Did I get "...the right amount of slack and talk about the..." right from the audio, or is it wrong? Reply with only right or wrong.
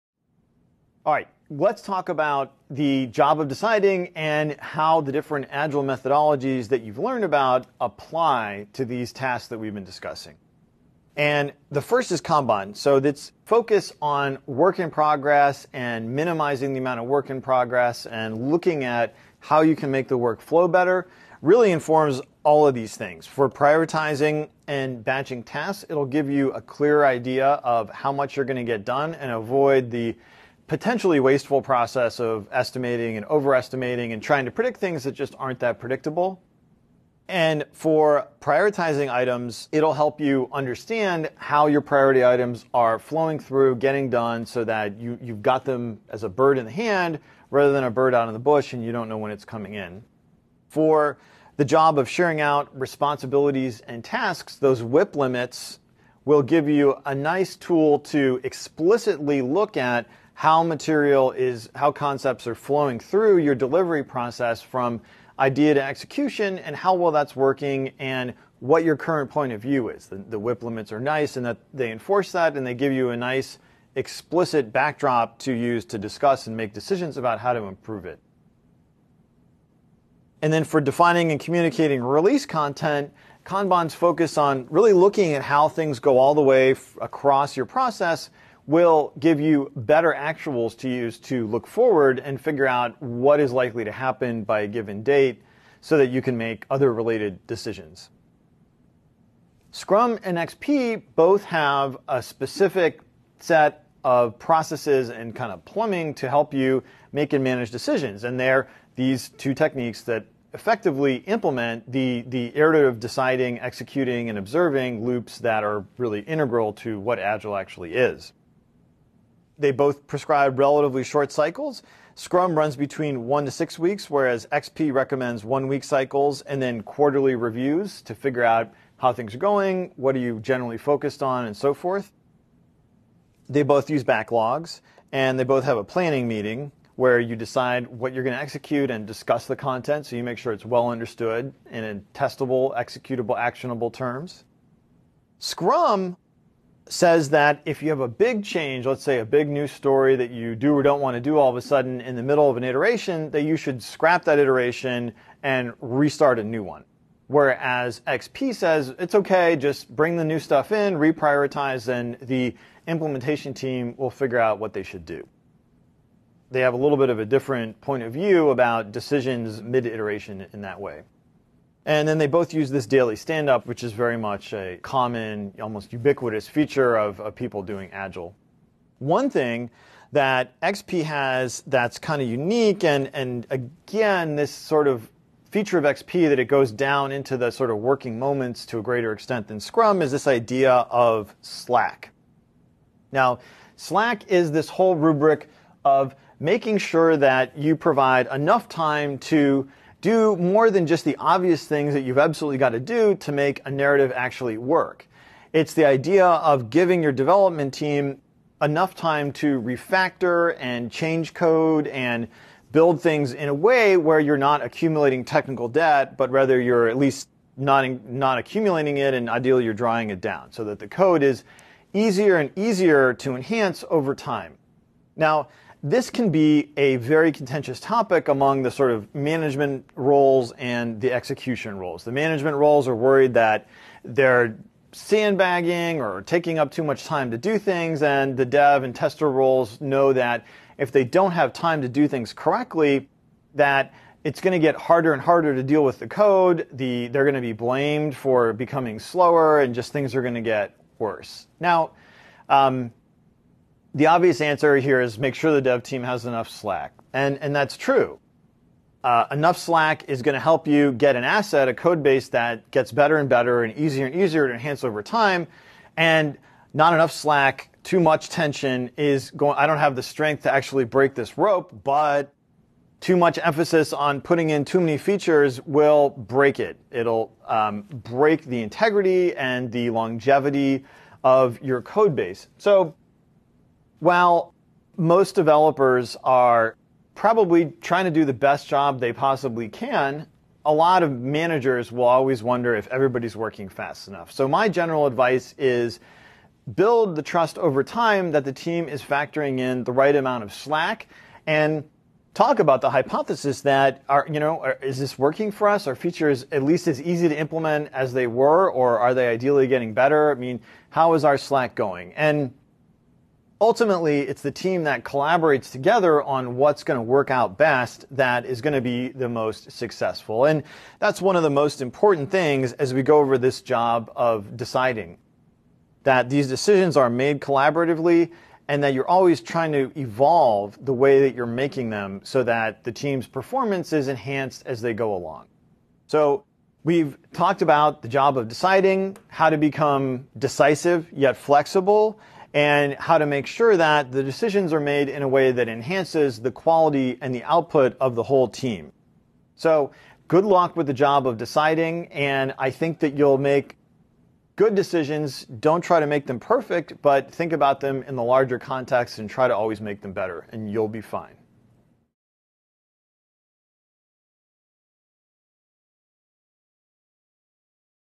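right.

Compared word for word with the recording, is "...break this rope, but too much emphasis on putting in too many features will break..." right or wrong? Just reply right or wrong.
right.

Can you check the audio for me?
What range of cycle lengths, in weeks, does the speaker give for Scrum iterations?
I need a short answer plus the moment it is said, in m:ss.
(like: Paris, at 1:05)
1 to 6 weeks, at 2:03.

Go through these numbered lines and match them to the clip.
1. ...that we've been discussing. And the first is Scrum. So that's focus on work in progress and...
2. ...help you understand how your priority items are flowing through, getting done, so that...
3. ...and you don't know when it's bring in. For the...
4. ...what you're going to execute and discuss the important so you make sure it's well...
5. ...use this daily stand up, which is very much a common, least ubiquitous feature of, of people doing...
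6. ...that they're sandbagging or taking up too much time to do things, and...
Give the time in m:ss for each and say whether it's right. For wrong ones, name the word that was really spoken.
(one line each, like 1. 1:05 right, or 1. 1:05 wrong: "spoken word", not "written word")
1. 0:09 wrong: "Kanban", not "Scrum"
2. 0:39 right
3. 0:48 wrong: "coming", not "bring"
4. 2:17 wrong: "content", not "important"
5. 2:52 wrong: "almost", not "least"
6. 3:53 right.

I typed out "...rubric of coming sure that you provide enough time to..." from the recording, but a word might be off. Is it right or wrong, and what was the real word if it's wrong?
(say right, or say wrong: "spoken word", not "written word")
wrong: "making", not "coming".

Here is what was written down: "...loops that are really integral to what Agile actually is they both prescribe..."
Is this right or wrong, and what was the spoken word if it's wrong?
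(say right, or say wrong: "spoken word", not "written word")
right.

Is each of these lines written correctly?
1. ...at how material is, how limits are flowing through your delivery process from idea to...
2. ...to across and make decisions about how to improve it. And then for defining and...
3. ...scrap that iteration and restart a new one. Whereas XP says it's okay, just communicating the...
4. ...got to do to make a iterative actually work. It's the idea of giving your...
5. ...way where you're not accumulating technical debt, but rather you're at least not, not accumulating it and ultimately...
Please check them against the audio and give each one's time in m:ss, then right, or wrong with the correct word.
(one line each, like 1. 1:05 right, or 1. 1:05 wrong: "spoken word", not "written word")
1. 0:59 wrong: "concepts", not "limits"
2. 1:15 wrong: "discuss", not "across"
3. 2:33 wrong: "bring", not "communicating"
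4. 3:22 wrong: "narrative", not "iterative"
5. 3:33 wrong: "ideally", not "ultimately".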